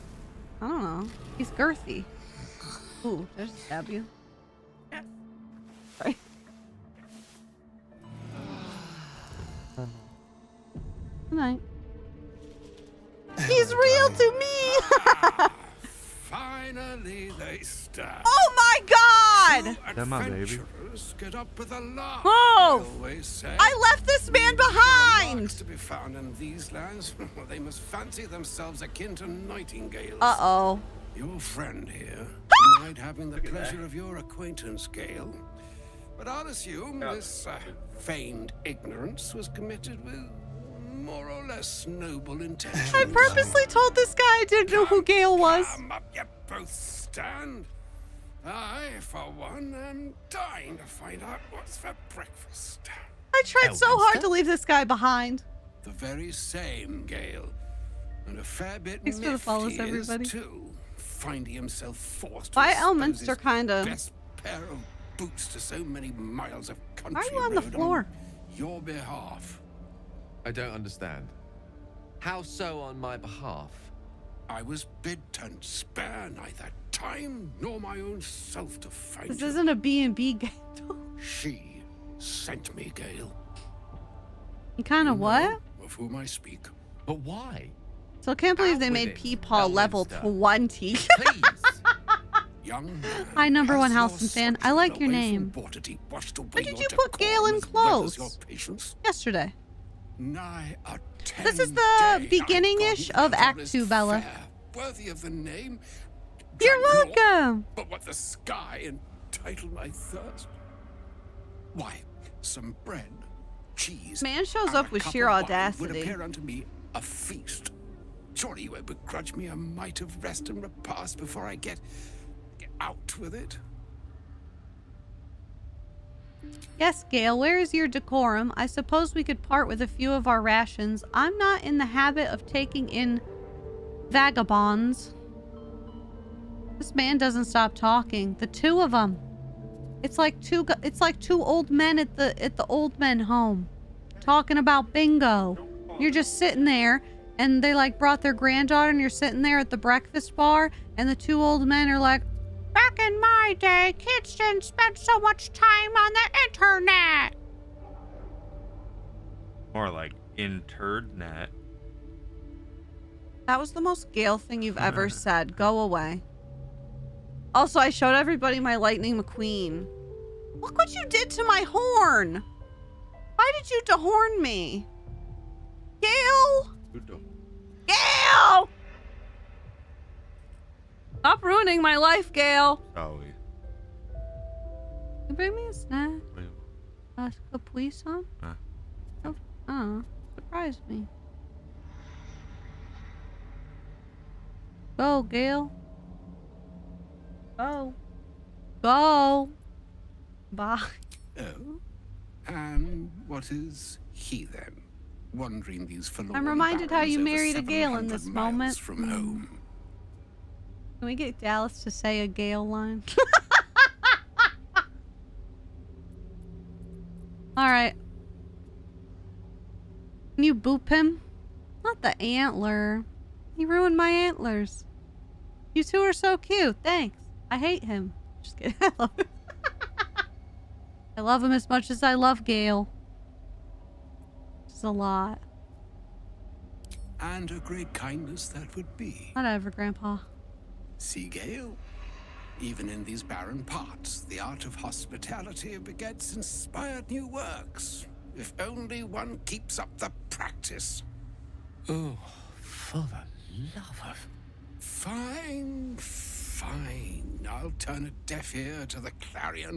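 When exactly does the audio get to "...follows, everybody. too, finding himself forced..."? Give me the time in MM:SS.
00:59.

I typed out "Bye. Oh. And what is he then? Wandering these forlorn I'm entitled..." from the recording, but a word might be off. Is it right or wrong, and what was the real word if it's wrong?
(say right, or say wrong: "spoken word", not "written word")
wrong: "reminded", not "entitled".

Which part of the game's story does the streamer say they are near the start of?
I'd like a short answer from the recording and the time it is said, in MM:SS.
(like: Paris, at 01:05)
Act Two, at 01:43.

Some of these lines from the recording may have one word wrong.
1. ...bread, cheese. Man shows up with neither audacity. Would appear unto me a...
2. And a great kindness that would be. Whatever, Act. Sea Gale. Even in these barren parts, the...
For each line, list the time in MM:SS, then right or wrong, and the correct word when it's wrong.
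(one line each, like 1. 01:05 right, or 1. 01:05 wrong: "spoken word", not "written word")
1. 01:52 wrong: "sheer", not "neither"
2. 03:57 wrong: "Grandpa", not "Act".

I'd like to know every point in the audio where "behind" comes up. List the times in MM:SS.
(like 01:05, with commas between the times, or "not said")
00:24, 00:54.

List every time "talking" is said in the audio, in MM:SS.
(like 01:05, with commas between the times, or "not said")
02:17, 02:24.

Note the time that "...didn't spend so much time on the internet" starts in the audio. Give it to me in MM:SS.
02:34.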